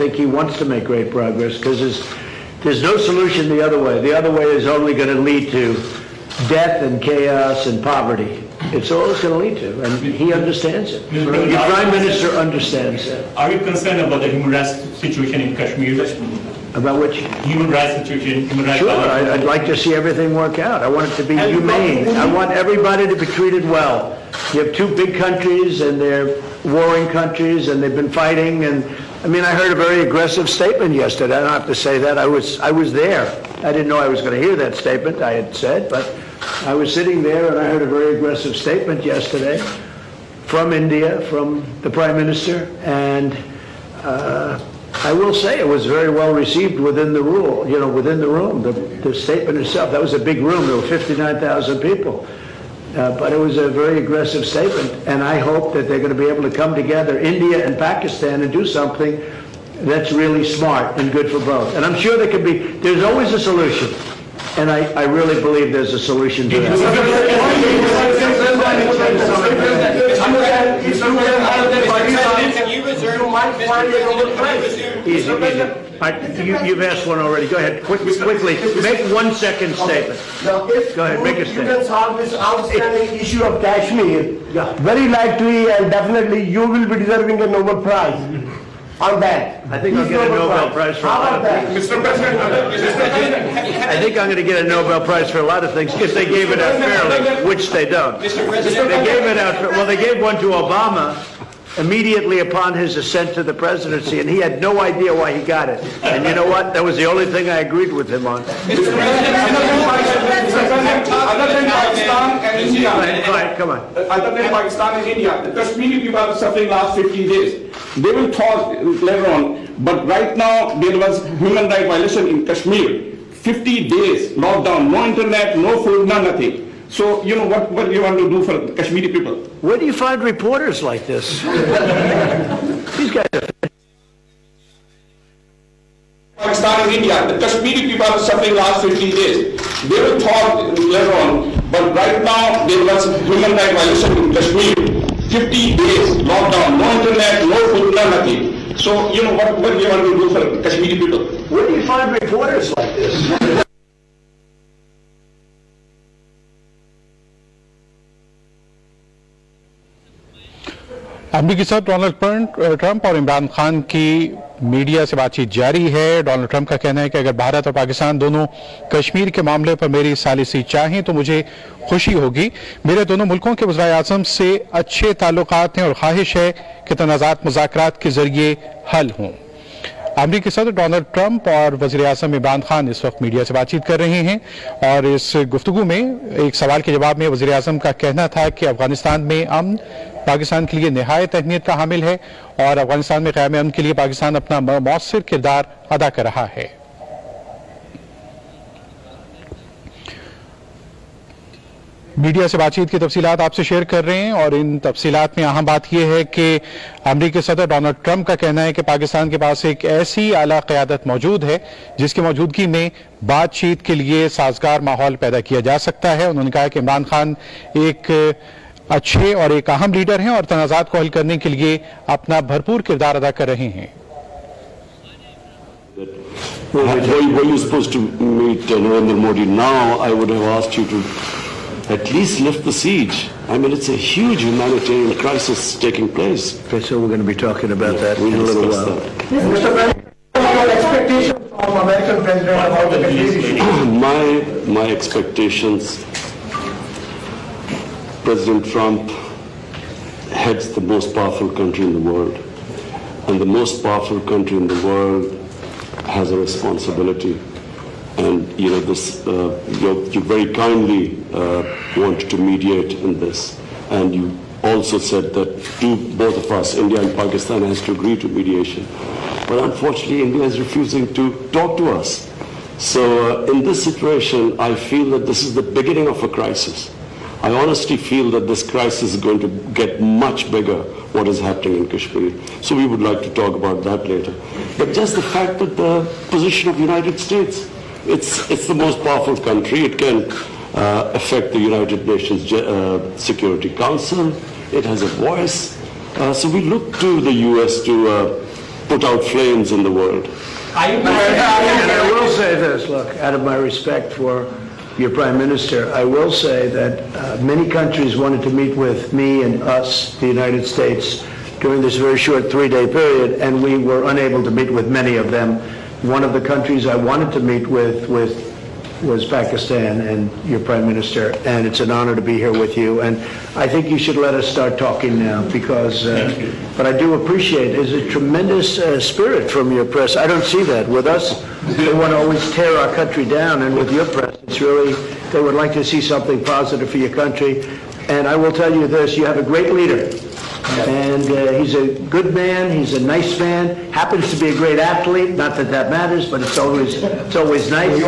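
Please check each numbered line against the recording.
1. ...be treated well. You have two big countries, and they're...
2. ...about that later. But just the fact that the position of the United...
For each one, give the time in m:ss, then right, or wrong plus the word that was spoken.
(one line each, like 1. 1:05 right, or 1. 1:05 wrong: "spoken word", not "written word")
1. 0:23 right
2. 4:43 right.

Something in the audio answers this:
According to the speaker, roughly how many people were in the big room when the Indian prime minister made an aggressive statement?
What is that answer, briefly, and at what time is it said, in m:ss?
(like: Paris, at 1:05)
59,000, at 0:50.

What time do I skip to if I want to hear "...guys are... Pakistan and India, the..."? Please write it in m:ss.
2:13.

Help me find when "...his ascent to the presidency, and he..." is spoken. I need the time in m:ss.
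1:42.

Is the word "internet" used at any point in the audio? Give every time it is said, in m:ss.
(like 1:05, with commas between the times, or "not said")
2:05, 2:26.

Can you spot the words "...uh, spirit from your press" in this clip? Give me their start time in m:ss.
5:28.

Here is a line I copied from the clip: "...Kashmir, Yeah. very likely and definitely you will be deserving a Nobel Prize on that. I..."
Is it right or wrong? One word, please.
right.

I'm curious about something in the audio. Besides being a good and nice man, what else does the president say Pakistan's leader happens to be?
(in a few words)
a great athlete.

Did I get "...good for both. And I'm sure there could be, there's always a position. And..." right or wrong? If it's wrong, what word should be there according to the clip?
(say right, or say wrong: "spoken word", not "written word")
wrong: "solution", not "position".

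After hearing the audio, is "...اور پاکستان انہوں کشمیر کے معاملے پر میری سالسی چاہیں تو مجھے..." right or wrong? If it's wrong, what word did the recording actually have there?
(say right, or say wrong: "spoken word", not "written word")
wrong: "دونوں", not "انہوں".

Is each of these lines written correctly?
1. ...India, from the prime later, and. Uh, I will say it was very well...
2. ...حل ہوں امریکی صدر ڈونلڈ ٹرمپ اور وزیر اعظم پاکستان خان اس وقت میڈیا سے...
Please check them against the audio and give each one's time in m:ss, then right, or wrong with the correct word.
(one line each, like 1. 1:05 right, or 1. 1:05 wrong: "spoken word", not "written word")
1. 0:40 wrong: "minister", not "later"
2. 2:58 wrong: "عمران", not "پاکستان".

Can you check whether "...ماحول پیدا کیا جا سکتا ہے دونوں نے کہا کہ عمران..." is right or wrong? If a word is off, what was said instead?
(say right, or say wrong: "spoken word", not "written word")
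wrong: "انہوں", not "دونوں".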